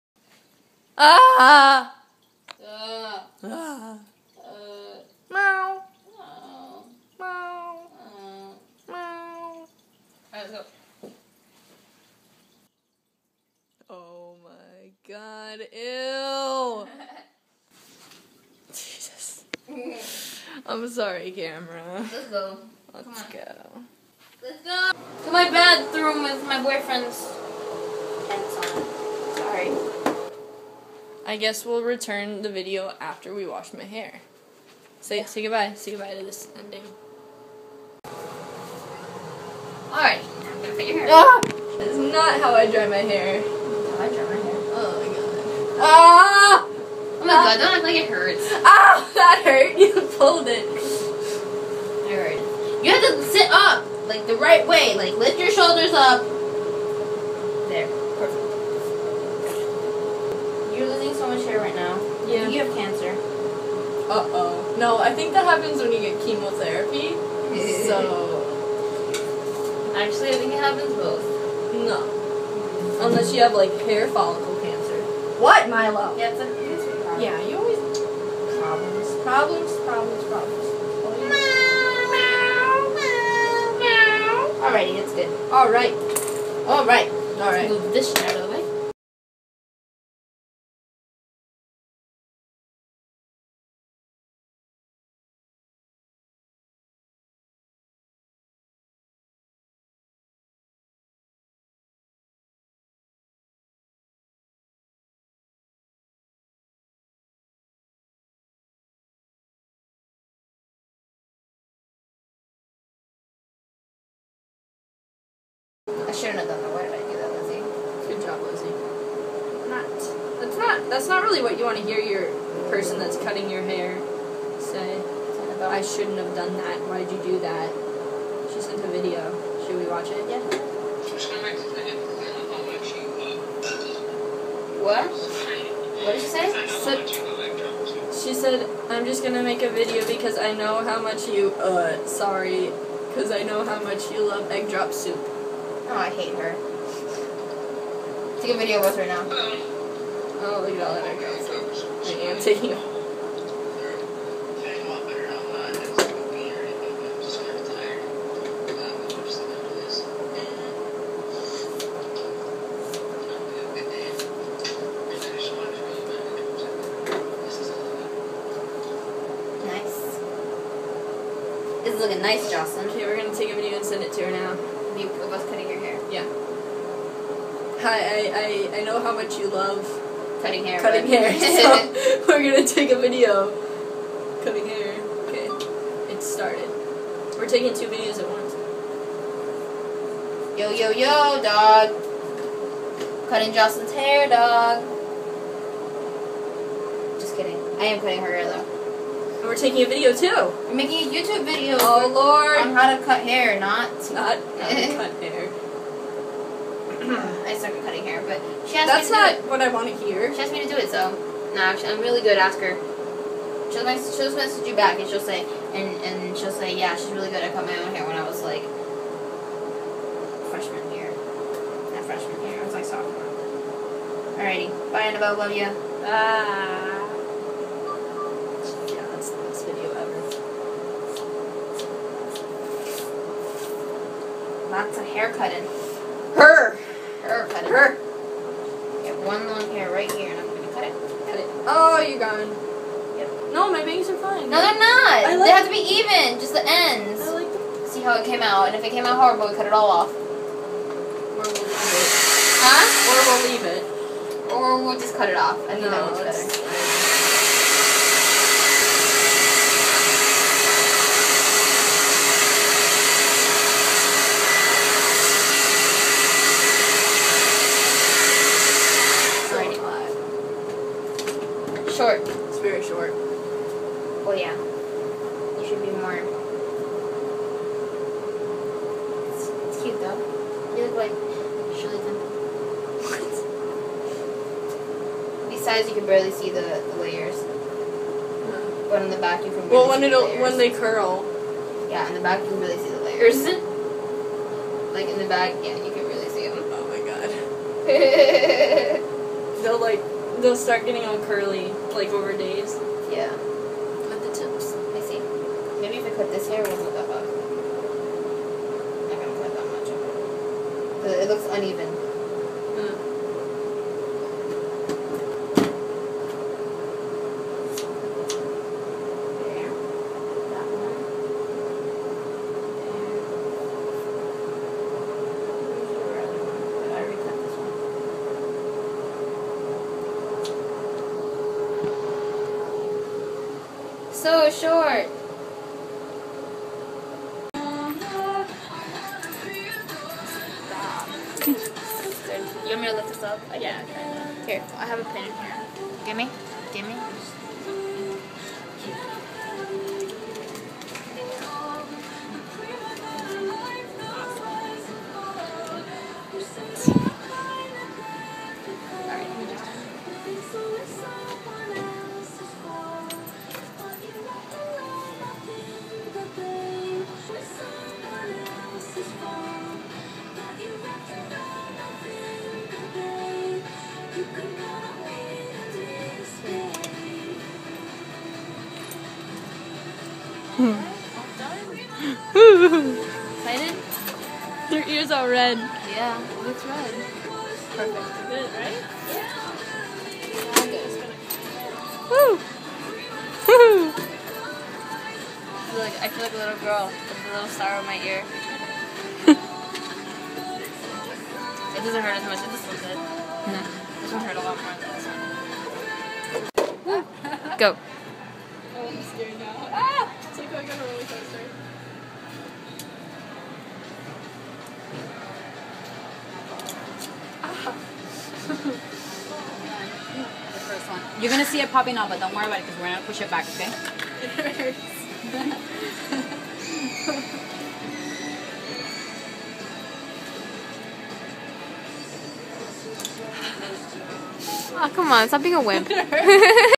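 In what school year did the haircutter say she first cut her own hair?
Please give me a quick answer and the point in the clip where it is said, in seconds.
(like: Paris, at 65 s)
sophomore, at 222 s.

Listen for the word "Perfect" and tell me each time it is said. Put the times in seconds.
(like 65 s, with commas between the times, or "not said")
386 s.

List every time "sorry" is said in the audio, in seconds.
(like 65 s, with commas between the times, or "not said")
20 s, 29 s, 142 s.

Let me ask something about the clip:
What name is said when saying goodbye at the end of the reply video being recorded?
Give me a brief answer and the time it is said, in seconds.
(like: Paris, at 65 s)
Annabelle, at 225 s.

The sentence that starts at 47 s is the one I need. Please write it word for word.
god, don't look like it hurts.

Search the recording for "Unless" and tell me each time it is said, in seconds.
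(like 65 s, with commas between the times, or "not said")
73 s.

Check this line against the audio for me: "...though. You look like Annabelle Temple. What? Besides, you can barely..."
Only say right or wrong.
wrong.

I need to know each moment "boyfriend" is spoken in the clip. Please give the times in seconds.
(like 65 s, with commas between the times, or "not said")
26 s.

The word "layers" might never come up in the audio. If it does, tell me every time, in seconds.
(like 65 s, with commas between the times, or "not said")
287 s, 293 s.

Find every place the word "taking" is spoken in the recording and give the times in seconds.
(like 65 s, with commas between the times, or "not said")
152 s, 187 s, 199 s.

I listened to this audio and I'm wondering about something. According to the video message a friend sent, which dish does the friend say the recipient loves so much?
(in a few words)
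egg drop soup.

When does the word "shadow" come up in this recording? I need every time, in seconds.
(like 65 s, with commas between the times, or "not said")
88 s.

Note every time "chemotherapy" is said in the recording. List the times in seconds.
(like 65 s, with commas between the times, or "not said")
66 s.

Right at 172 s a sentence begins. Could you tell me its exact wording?
Okay, we're gonna take a video and send it to her now.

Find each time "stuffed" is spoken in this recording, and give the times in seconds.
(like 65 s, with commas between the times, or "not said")
not said.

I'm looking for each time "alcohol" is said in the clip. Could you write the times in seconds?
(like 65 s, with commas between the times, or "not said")
not said.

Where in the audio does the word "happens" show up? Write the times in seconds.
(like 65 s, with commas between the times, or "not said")
65 s, 70 s.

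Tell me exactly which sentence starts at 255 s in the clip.
I think no, that one's better.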